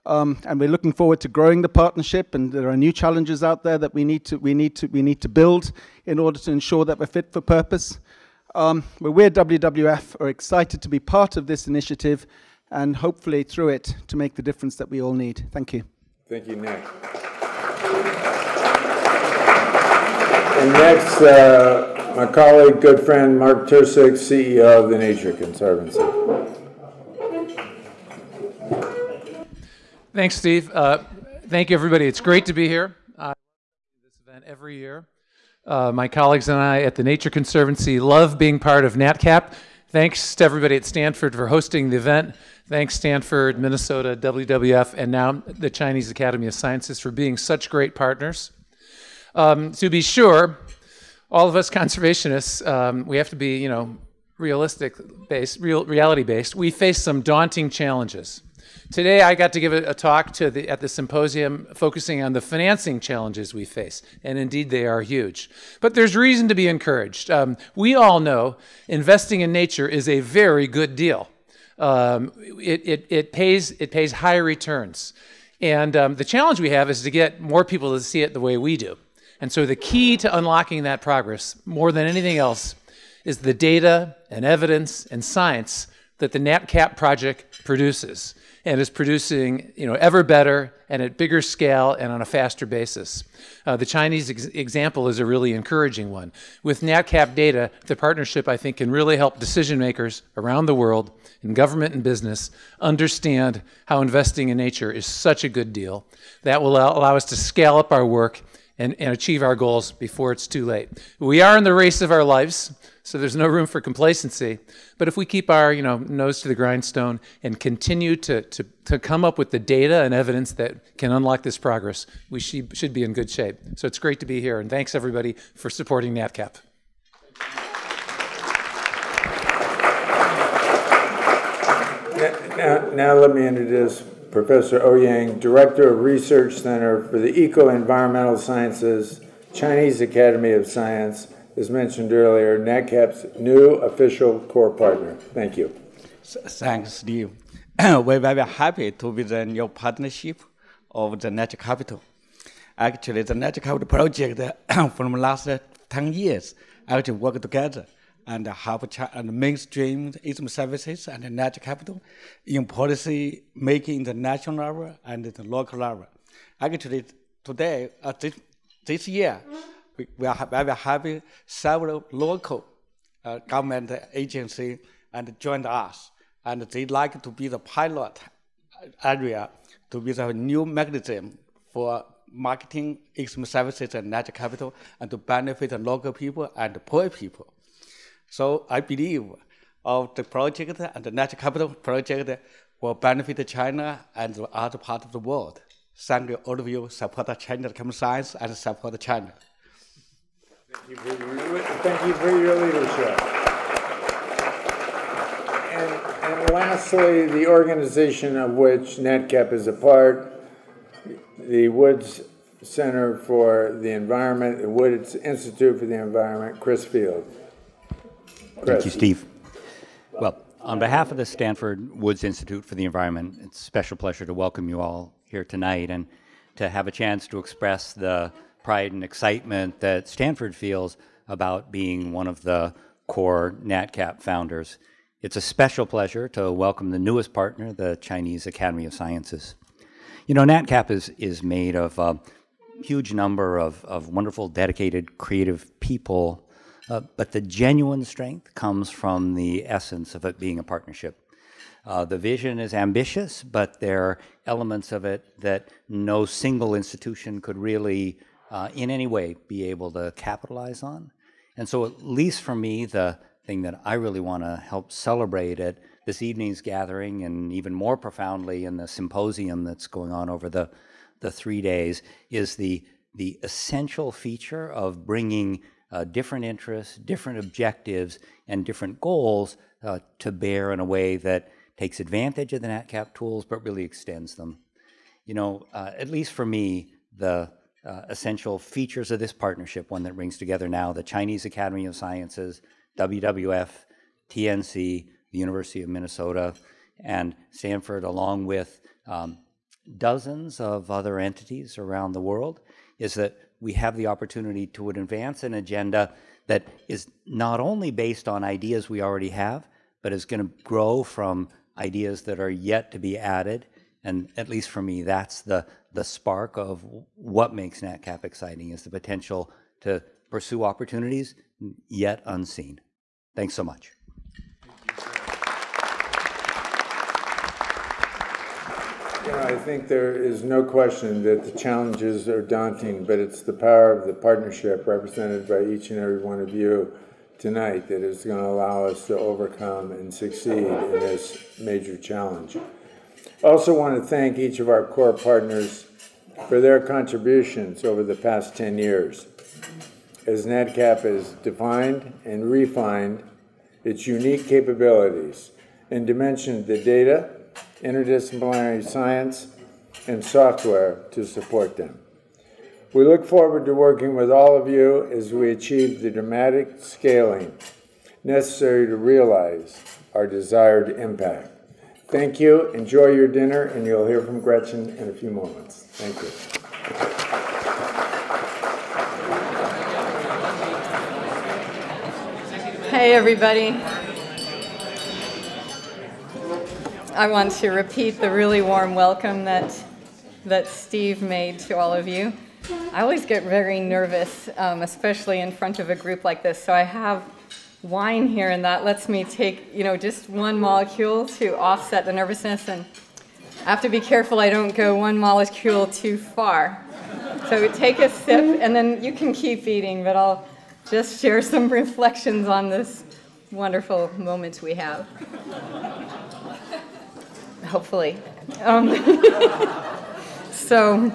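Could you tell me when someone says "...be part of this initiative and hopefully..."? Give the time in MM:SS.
00:10.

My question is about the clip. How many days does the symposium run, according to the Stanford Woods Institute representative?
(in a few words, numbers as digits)
3.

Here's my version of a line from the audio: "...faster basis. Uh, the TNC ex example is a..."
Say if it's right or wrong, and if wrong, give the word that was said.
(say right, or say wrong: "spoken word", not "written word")
wrong: "Chinese", not "TNC".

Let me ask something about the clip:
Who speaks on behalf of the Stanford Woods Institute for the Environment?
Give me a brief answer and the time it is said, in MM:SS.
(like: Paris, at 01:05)
Chris Field, at 03:36.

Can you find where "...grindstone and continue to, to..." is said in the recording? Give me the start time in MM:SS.
01:56.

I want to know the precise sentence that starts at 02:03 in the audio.
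So it's great to be here.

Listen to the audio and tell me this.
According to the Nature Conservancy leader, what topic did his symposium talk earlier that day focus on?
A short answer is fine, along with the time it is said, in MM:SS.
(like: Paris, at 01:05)
financing challenges, at 01:02.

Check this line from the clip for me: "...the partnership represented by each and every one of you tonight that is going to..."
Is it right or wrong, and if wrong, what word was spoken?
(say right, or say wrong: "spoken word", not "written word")
right.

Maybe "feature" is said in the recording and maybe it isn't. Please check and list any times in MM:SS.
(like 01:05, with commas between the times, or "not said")
04:34, 04:48.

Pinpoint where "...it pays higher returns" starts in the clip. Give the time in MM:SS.
01:13.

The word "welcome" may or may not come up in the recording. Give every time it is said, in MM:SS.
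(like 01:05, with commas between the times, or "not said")
03:44, 03:56, 06:28.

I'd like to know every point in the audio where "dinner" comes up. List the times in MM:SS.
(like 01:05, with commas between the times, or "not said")
06:13.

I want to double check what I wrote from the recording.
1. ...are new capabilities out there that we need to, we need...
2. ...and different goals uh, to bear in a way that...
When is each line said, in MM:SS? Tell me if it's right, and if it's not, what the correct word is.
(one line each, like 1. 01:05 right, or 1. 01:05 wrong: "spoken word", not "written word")
1. 00:02 wrong: "challenges", not "capabilities"
2. 04:38 right.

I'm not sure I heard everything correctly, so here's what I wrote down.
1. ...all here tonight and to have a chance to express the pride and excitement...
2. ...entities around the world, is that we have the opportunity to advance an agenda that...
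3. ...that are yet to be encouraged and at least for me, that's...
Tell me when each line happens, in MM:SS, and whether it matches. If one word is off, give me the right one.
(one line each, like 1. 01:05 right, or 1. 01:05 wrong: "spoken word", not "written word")
1. 03:44 right
2. 05:01 right
3. 05:12 wrong: "added", not "encouraged".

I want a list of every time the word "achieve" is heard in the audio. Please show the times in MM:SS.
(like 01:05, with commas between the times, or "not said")
01:49, 06:05.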